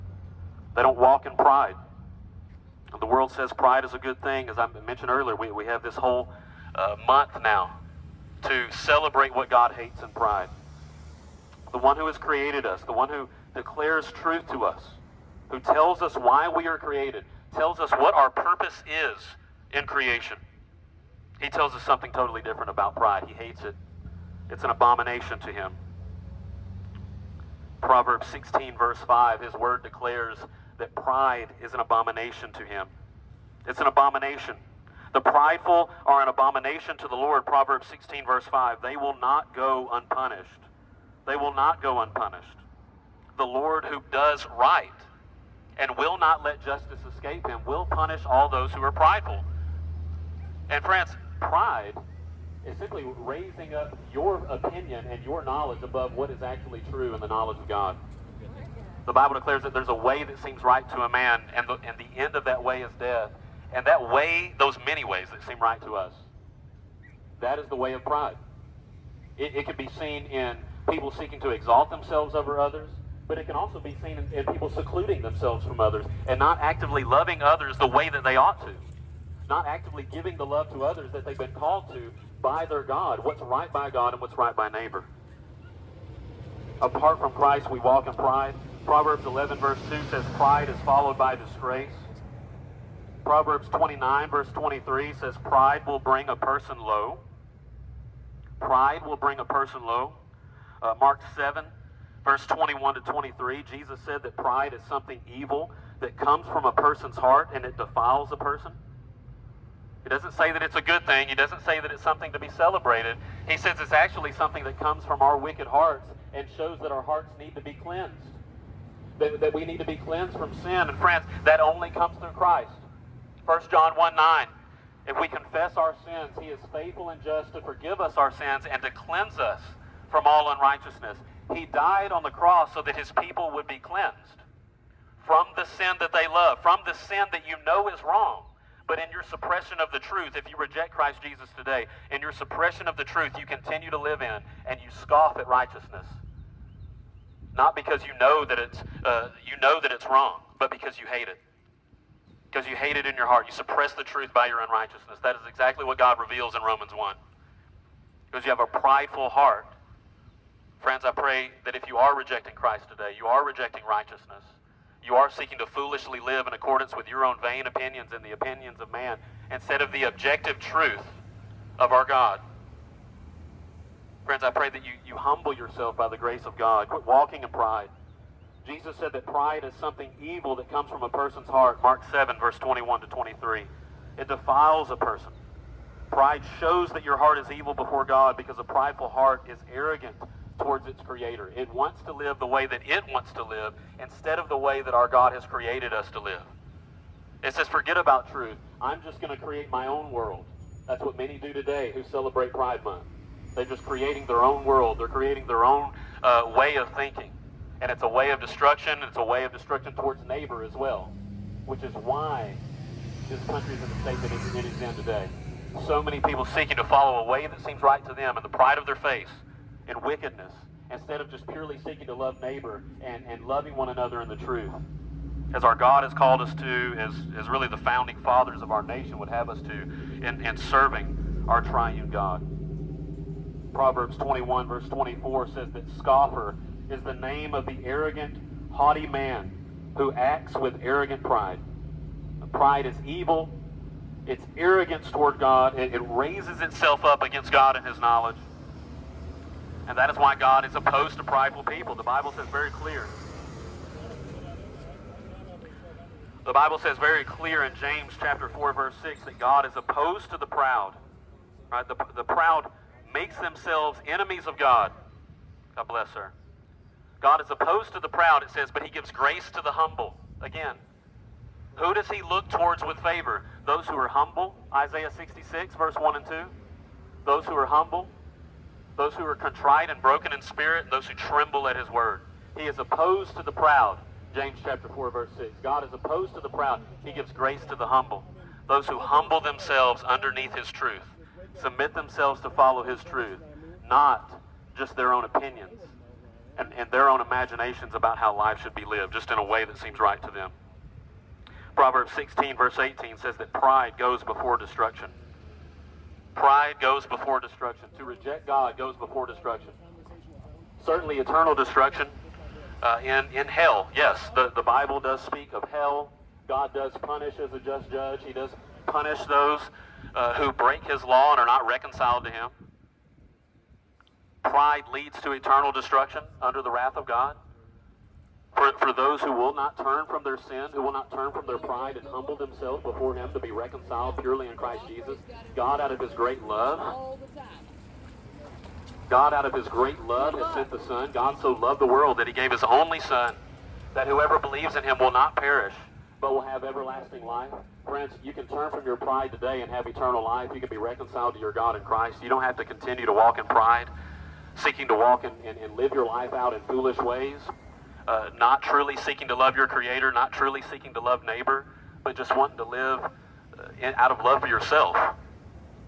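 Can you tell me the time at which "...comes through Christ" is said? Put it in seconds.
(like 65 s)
121 s.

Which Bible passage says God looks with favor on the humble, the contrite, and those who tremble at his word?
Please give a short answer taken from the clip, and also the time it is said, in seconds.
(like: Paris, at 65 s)
Isaiah 66:1-2, at 274 s.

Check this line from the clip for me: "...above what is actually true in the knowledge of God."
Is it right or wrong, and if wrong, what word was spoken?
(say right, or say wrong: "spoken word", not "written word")
right.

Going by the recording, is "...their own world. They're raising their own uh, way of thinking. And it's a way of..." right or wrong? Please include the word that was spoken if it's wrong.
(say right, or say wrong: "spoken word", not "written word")
wrong: "creating", not "raising".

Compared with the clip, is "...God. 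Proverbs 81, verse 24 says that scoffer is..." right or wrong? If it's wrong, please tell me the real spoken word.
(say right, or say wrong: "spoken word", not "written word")
wrong: "21", not "81".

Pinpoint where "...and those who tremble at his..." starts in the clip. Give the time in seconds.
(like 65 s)
280 s.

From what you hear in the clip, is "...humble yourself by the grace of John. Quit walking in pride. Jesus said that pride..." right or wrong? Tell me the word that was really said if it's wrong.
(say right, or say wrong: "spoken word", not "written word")
wrong: "God", not "John".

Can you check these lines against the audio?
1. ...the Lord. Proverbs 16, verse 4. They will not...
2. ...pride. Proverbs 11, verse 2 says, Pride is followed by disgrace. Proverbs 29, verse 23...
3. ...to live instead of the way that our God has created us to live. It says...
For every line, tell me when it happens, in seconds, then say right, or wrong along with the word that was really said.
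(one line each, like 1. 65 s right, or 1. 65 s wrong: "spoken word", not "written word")
1. 37 s wrong: "5", not "4"
2. 88 s right
3. 193 s right.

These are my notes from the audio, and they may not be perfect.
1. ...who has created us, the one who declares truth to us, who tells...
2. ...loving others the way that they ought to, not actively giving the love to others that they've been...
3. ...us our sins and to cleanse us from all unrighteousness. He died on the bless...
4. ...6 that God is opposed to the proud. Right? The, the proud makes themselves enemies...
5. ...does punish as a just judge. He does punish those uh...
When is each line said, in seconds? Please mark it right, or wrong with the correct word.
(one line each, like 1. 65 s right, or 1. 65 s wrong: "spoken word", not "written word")
1. 11 s right
2. 77 s right
3. 127 s wrong: "cross", not "bless"
4. 259 s right
5. 316 s right.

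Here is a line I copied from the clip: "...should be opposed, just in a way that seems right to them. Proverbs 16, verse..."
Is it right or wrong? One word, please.
wrong.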